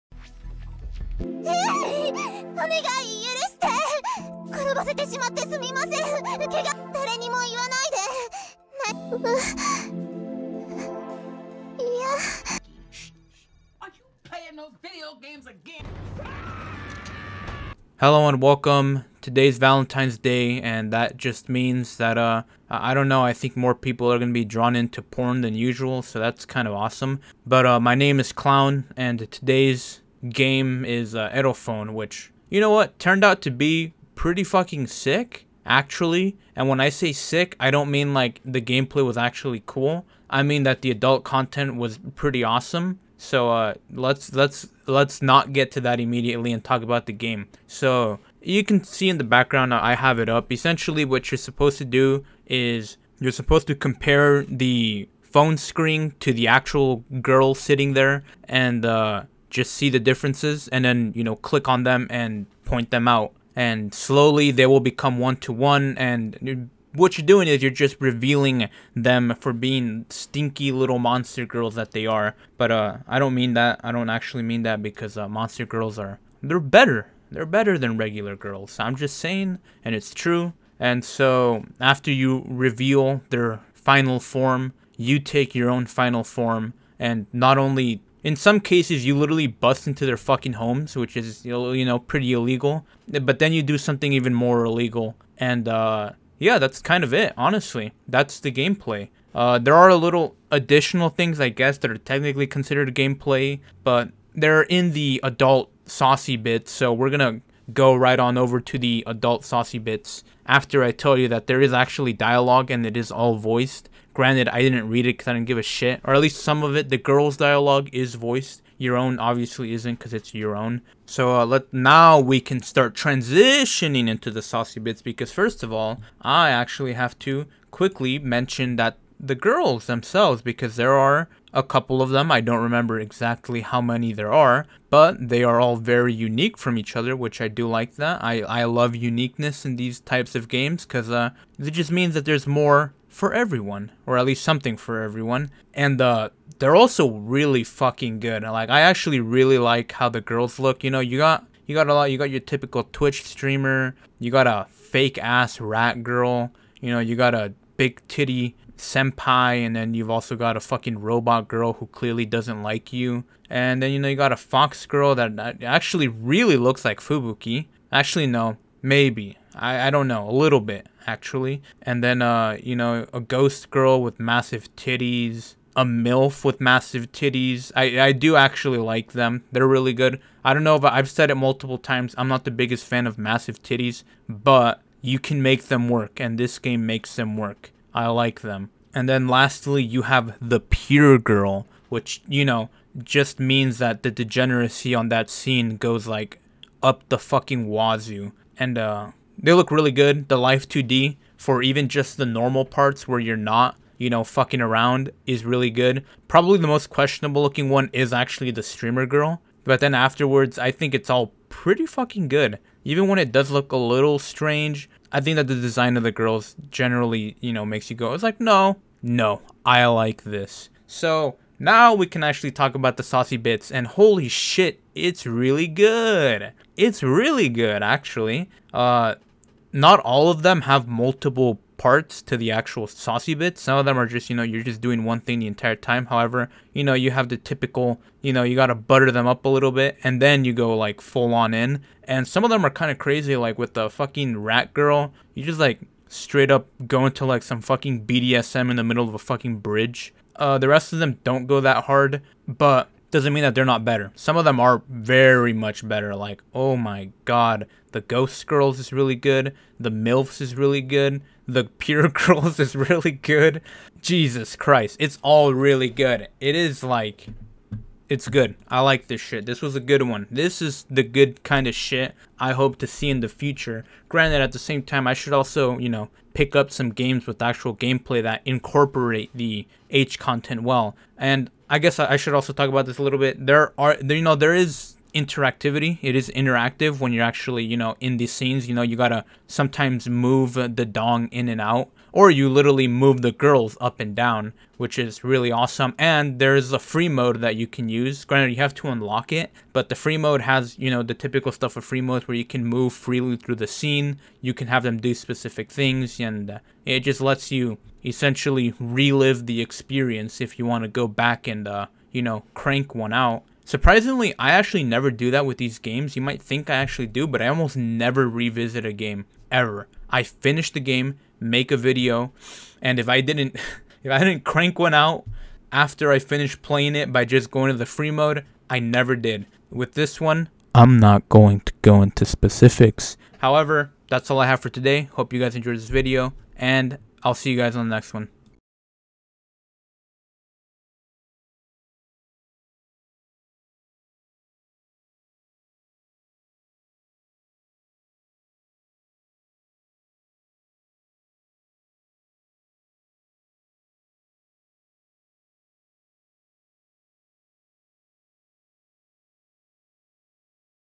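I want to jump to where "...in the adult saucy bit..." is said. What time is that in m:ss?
1:44.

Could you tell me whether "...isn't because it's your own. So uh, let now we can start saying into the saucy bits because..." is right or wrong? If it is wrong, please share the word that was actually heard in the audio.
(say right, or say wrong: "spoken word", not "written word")
wrong: "transitioning", not "saying".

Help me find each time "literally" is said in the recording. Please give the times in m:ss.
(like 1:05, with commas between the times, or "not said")
1:29, 4:52.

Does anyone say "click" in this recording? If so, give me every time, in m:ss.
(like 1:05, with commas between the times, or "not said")
1:01.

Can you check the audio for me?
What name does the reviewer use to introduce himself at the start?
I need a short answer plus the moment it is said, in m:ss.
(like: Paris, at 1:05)
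Clown, at 0:28.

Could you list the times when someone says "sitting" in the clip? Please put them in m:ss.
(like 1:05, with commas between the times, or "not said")
0:57.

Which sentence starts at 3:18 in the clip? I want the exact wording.
And uh, they look really good.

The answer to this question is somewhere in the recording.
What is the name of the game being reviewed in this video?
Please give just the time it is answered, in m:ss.
0:31.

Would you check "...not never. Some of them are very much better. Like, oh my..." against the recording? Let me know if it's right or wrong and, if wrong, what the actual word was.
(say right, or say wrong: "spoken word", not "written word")
wrong: "better", not "never".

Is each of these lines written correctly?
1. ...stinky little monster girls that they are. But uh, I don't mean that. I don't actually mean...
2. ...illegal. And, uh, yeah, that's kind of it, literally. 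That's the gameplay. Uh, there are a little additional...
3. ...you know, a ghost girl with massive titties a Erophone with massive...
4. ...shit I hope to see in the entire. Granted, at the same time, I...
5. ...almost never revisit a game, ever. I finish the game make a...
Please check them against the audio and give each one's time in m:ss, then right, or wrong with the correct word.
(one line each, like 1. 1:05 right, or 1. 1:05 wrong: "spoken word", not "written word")
1. 1:10 right
2. 1:34 wrong: "honestly", not "literally"
3. 2:52 wrong: "MILF", not "Erophone"
4. 4:31 wrong: "future", not "entire"
5. 5:17 right.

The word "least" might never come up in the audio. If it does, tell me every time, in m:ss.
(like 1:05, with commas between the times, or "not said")
1:56, 2:24.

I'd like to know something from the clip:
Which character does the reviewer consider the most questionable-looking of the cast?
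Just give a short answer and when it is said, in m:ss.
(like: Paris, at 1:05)
The streamer girl, at 3:28.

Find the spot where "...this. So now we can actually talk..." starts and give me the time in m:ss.
3:40.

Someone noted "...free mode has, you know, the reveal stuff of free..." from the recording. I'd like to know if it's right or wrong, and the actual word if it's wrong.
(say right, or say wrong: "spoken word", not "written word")
wrong: "typical", not "reveal".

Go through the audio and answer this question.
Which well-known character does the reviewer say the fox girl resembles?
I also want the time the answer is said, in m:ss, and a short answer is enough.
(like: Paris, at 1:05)
Fubuki, at 2:46.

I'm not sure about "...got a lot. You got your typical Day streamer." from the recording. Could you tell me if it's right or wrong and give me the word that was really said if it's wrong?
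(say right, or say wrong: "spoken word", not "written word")
wrong: "Twitch", not "Day".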